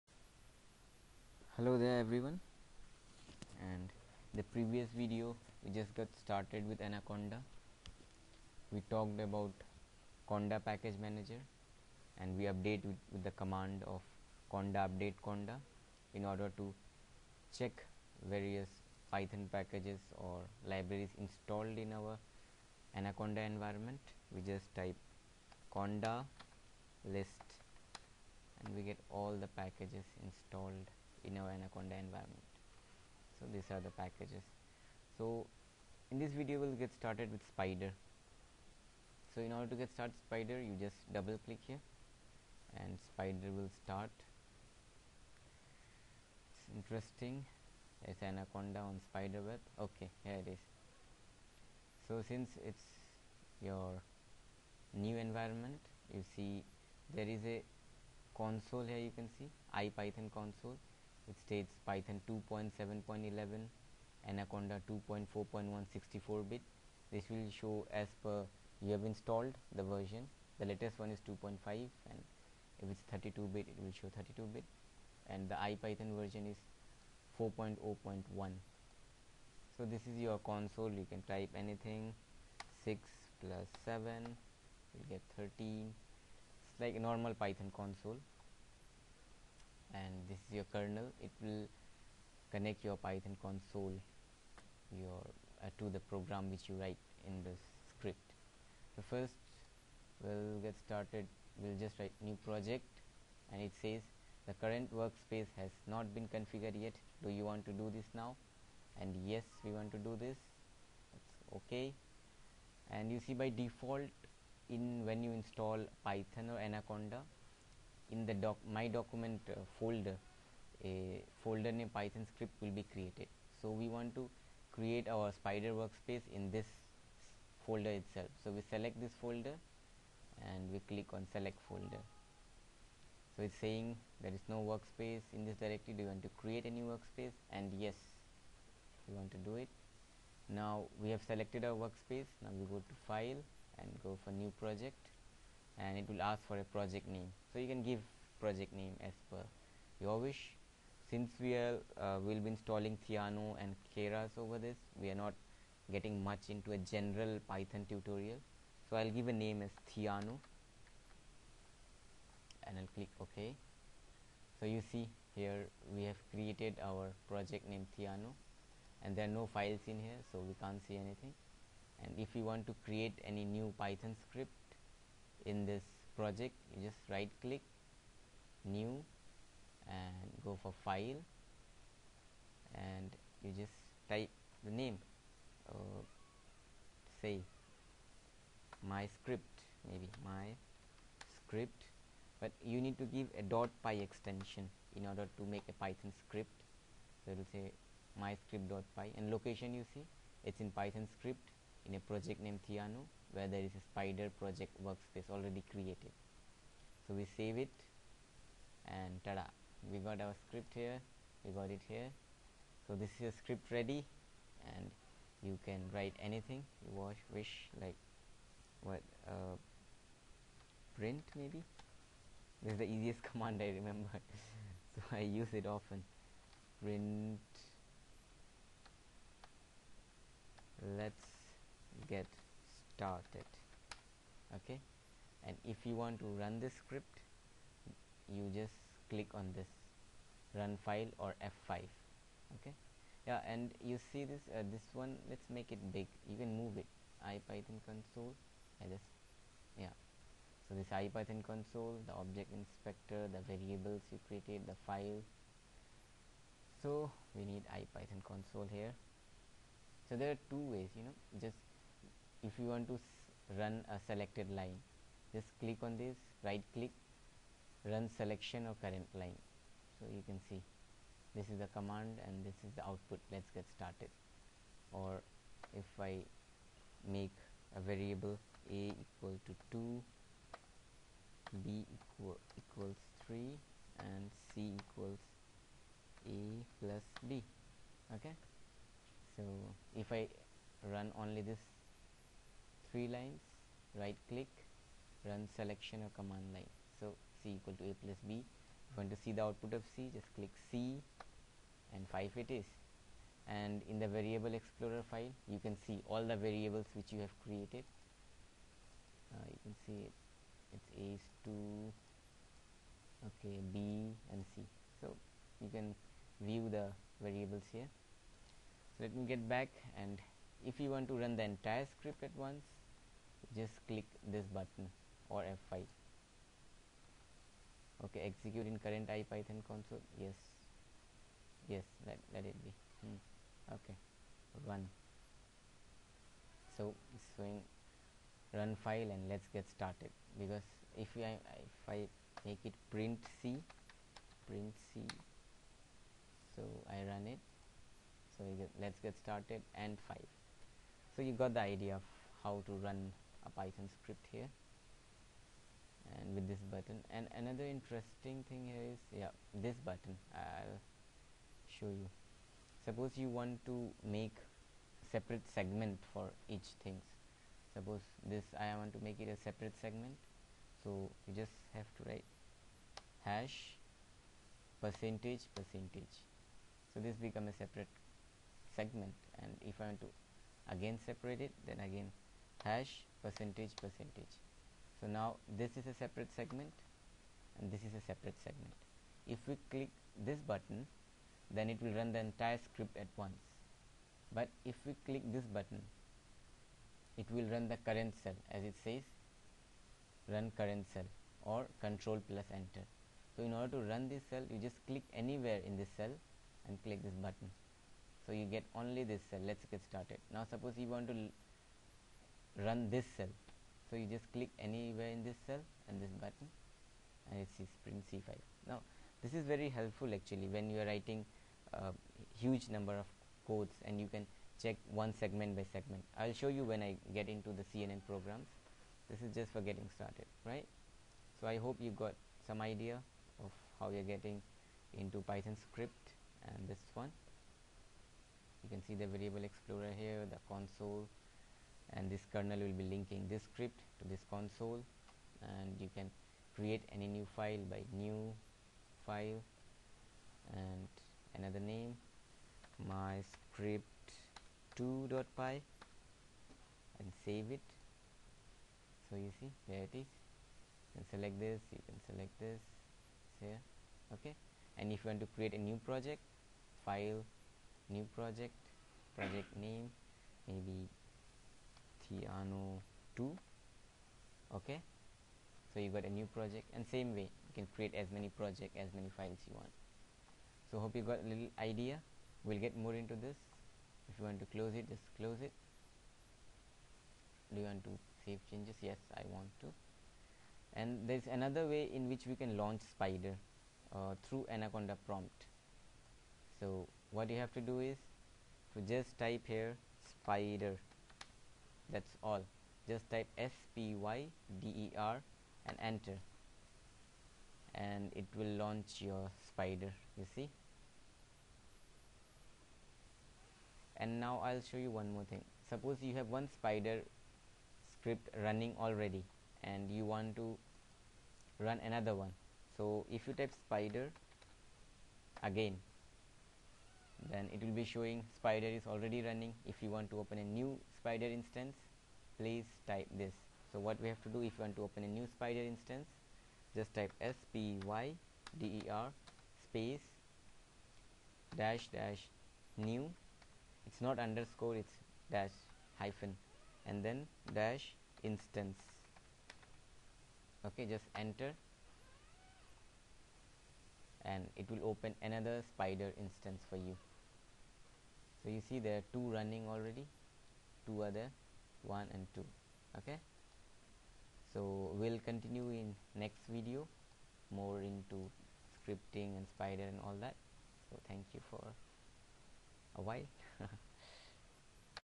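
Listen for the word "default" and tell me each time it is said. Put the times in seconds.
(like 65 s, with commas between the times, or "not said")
113 s.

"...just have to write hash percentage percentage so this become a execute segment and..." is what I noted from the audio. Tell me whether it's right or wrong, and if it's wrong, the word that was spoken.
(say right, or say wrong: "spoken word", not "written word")
wrong: "separate", not "execute".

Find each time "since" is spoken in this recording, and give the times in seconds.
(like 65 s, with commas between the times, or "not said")
52 s, 151 s.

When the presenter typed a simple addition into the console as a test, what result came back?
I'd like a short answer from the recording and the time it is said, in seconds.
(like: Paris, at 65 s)
13, at 85 s.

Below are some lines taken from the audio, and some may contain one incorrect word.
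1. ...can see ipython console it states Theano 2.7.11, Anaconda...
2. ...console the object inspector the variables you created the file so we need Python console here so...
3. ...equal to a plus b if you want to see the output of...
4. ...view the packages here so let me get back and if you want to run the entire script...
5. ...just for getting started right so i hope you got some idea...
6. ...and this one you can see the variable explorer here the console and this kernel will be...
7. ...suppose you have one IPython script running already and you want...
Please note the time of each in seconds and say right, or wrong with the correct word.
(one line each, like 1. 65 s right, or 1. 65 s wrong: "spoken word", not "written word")
1. 59 s wrong: "Python", not "Theano"
2. 251 s wrong: "IPython", not "Python"
3. 297 s right
4. 316 s wrong: "variables", not "packages"
5. 429 s right
6. 436 s right
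7. 515 s wrong: "Spyder", not "IPython".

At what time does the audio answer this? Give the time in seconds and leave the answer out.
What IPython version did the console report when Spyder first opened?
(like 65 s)
77 s.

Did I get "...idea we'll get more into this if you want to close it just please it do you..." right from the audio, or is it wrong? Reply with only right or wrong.
wrong.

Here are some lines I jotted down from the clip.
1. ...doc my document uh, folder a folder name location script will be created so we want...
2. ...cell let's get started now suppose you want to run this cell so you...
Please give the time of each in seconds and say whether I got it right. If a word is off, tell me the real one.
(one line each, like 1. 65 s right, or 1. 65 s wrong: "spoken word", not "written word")
1. 118 s wrong: "python", not "location"
2. 409 s right.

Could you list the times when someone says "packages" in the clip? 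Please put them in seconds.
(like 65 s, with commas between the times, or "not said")
10 s, 19 s, 29 s, 33 s.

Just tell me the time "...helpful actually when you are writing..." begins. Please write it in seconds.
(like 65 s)
419 s.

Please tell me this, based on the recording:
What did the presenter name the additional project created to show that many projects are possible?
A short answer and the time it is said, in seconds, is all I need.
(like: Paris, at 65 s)
Theano 2, at 472 s.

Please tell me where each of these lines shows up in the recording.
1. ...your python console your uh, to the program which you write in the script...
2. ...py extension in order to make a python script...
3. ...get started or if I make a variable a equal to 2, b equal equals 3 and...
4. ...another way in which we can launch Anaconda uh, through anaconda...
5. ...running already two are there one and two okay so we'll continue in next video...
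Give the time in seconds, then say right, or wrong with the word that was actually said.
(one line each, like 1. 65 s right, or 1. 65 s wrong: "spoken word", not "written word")
1. 92 s right
2. 193 s right
3. 273 s right
4. 491 s wrong: "Spyder", not "Anaconda"
5. 559 s right.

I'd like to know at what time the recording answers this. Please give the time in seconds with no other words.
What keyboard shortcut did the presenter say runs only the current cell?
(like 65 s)
401 s.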